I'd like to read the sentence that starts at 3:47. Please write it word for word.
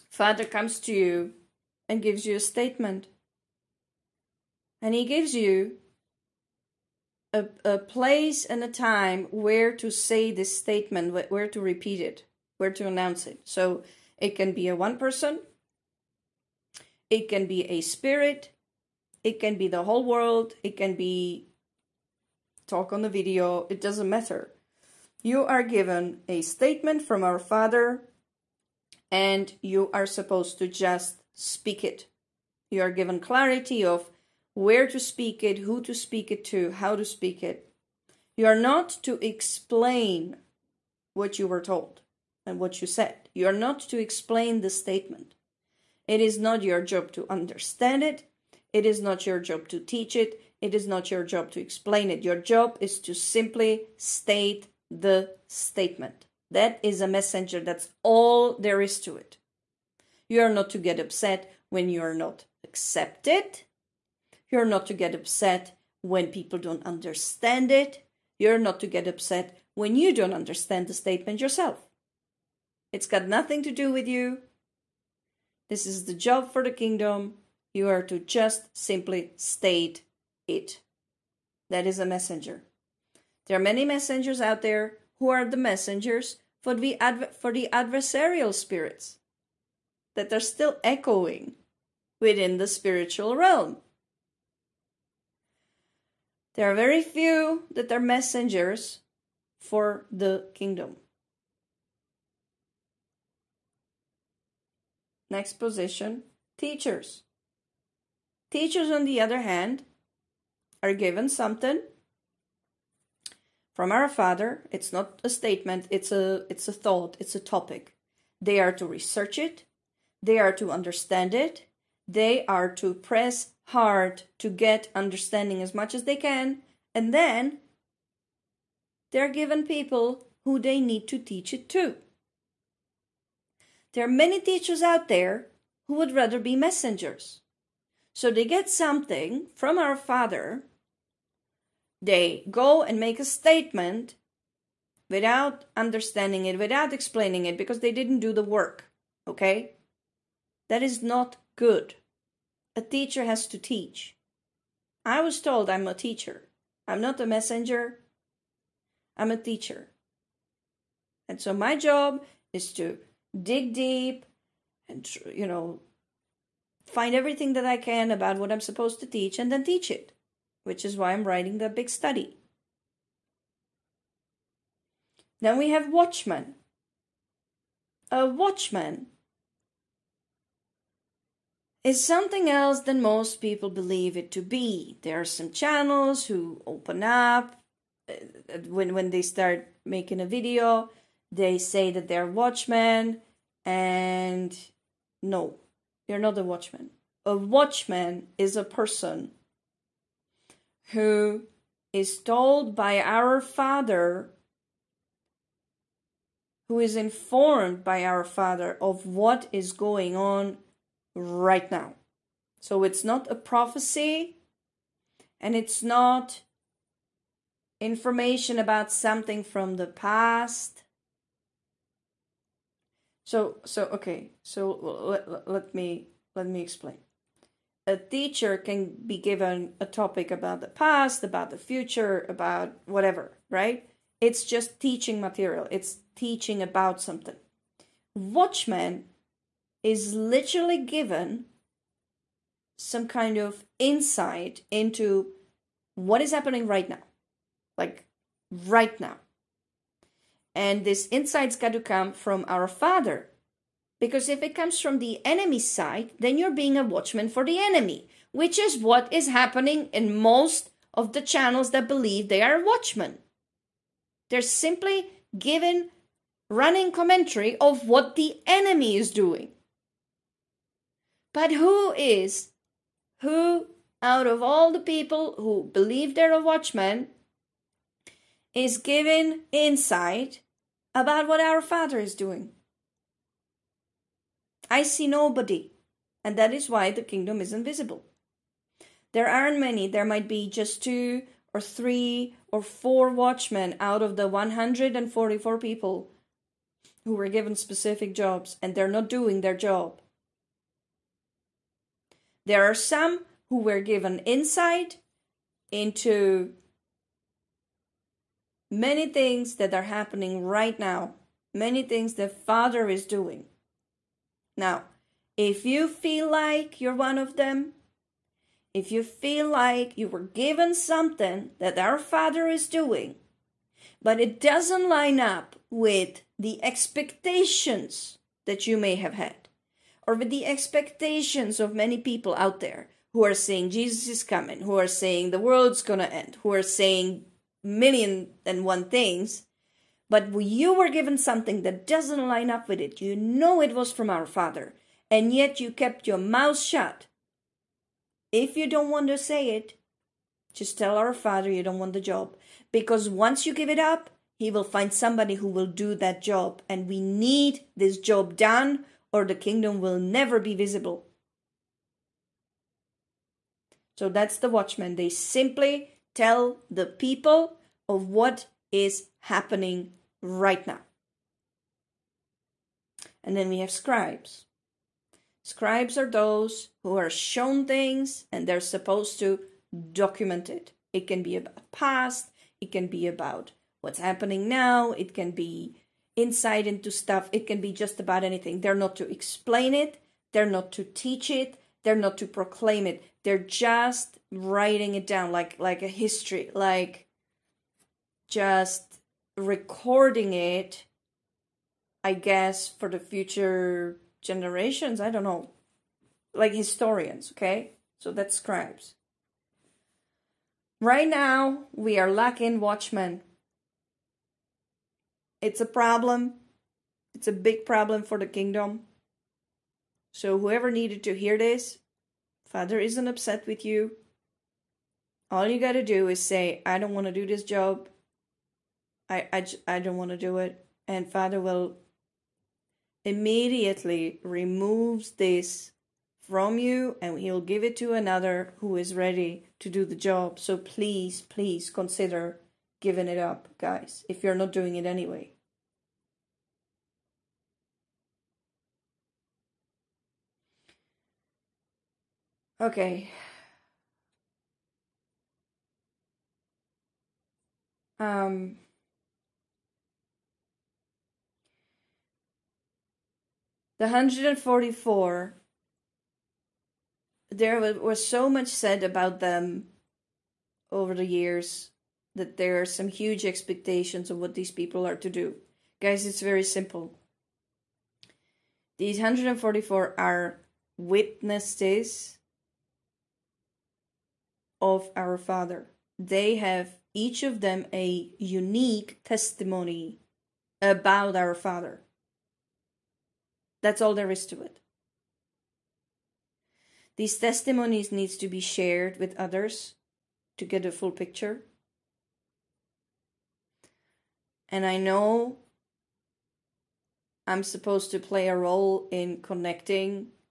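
A teacher can be given a topic about the past, about the future, about whatever, right?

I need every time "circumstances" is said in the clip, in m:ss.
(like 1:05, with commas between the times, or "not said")
not said.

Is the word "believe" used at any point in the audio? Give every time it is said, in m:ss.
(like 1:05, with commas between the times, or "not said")
3:03, 4:21, 4:35.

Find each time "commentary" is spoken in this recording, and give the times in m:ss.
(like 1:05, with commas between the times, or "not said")
4:26.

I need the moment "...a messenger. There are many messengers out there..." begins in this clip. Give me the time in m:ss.
1:21.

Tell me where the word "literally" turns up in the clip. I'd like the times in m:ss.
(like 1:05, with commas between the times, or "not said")
4:00.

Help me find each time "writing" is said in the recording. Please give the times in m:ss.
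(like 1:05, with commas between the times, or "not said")
2:51, 6:34.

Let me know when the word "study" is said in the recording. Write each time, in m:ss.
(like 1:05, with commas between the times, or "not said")
2:51.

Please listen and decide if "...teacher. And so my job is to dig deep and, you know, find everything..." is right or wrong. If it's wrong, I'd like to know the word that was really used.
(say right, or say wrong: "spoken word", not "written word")
right.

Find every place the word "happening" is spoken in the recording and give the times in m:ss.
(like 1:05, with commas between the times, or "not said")
4:06, 4:19, 5:09, 6:09, 6:23.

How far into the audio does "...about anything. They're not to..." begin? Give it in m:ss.
6:27.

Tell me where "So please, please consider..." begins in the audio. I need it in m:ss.
7:20.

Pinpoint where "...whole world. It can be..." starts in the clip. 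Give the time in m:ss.
0:19.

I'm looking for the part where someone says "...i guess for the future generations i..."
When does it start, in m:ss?
6:42.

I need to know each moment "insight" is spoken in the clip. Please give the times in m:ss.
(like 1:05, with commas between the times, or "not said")
4:03, 4:11, 4:39, 5:04, 6:26.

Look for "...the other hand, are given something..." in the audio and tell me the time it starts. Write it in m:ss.
1:49.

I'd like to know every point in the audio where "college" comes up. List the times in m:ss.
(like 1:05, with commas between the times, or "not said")
not said.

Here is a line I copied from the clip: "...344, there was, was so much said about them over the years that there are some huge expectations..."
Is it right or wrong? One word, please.
wrong.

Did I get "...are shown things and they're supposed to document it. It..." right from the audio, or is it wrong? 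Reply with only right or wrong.
right.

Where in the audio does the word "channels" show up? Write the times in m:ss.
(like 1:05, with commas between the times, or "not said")
3:05, 4:21.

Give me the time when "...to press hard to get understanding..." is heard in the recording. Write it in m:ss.
2:02.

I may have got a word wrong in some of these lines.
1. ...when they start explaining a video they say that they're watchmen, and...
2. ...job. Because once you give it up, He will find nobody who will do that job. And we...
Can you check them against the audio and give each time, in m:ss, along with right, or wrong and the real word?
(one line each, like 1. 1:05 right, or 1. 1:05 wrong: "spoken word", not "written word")
1. 3:08 wrong: "making", not "explaining"
2. 5:52 wrong: "somebody", not "nobody".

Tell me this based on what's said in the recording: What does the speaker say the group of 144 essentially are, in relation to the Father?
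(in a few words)
Witnesses.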